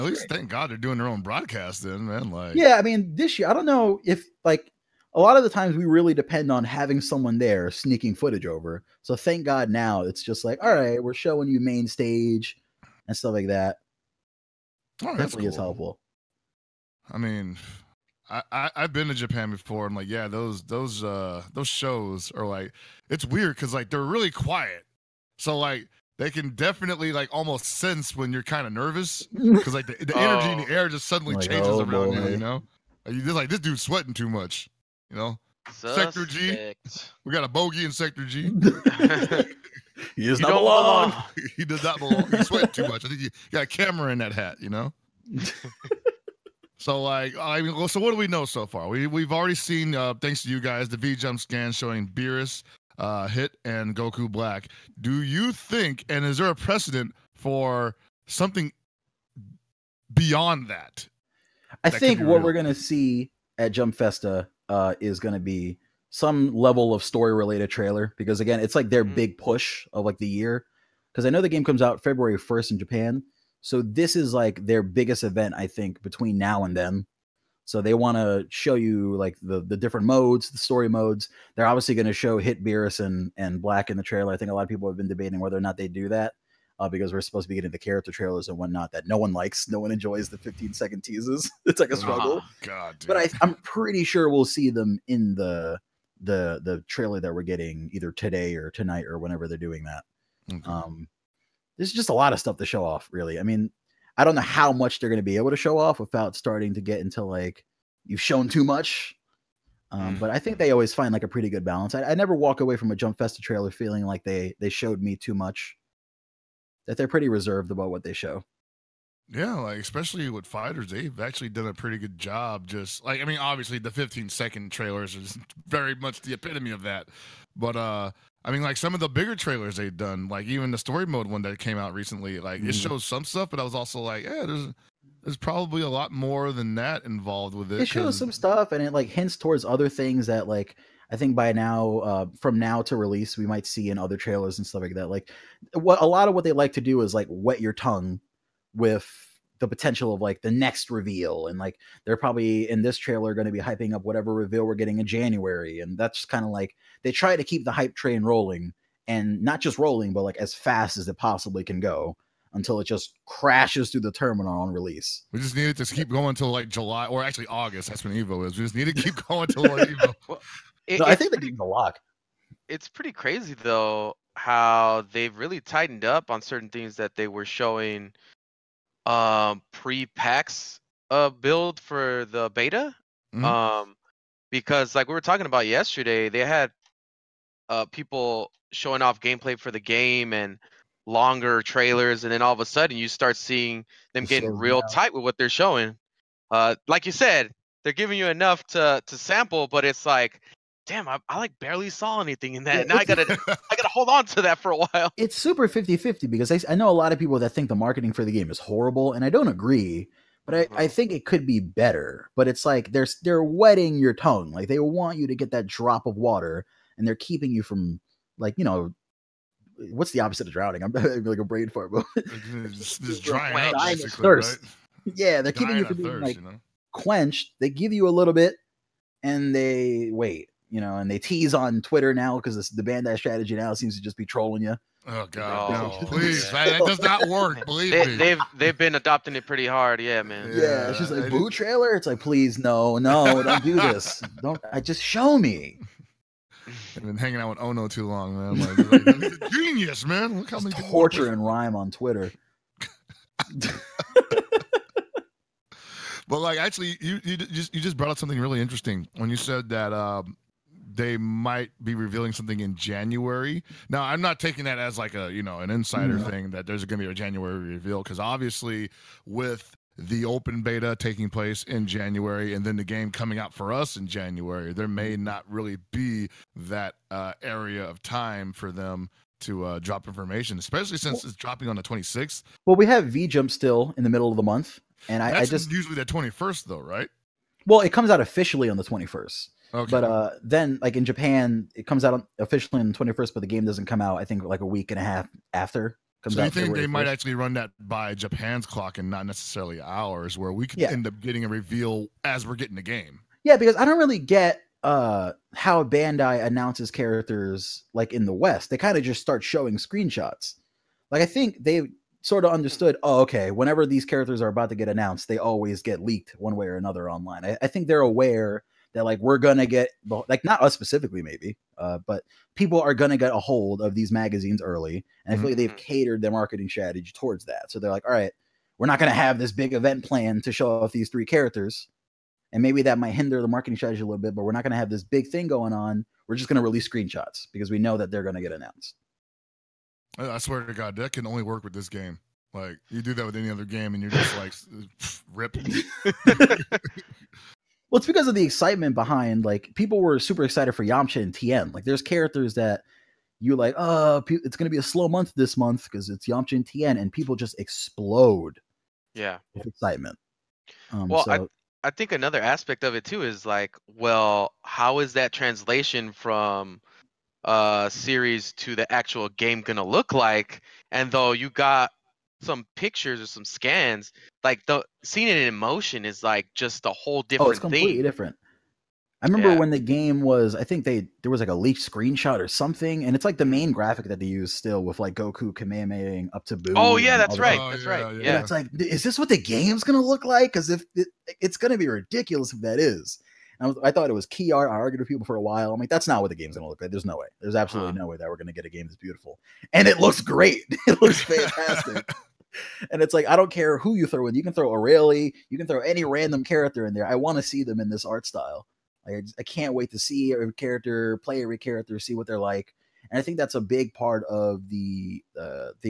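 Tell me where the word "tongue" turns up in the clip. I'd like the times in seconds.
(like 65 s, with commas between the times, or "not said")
147 s, 214 s.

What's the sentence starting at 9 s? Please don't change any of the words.
So thank God now it's just like, all right, we're showing you main stage and stuff like that.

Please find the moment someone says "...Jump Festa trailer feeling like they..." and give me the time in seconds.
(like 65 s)
112 s.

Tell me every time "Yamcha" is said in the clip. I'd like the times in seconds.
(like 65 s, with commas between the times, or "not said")
350 s, 356 s.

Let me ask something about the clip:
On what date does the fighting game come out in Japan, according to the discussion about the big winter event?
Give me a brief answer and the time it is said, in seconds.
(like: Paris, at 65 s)
February 1st, at 72 s.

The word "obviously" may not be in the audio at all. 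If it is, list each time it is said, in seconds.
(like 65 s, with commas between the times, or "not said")
81 s, 123 s, 268 s.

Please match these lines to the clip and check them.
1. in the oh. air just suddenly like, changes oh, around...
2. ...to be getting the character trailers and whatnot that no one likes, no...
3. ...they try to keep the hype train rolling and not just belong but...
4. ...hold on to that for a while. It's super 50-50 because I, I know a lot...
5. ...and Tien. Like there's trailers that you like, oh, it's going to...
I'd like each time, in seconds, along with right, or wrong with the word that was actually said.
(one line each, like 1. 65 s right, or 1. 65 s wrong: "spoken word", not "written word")
1. 30 s right
2. 87 s right
3. 157 s wrong: "rolling", not "belong"
4. 203 s right
5. 351 s wrong: "characters", not "trailers".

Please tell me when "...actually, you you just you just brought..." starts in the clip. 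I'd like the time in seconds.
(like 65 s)
256 s.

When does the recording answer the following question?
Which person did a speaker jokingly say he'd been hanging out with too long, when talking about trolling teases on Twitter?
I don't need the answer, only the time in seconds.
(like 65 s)
247 s.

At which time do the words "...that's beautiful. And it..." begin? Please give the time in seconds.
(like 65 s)
398 s.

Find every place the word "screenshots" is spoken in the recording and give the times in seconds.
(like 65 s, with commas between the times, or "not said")
309 s, 336 s, 381 s.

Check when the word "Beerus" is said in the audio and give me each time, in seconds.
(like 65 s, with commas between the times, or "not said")
52 s, 82 s.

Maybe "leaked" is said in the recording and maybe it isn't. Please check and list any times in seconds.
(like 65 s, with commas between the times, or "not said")
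316 s, 381 s.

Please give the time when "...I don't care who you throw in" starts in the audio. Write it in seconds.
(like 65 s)
403 s.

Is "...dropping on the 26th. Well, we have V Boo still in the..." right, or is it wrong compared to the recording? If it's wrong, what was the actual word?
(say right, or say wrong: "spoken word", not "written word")
wrong: "Jump", not "Boo".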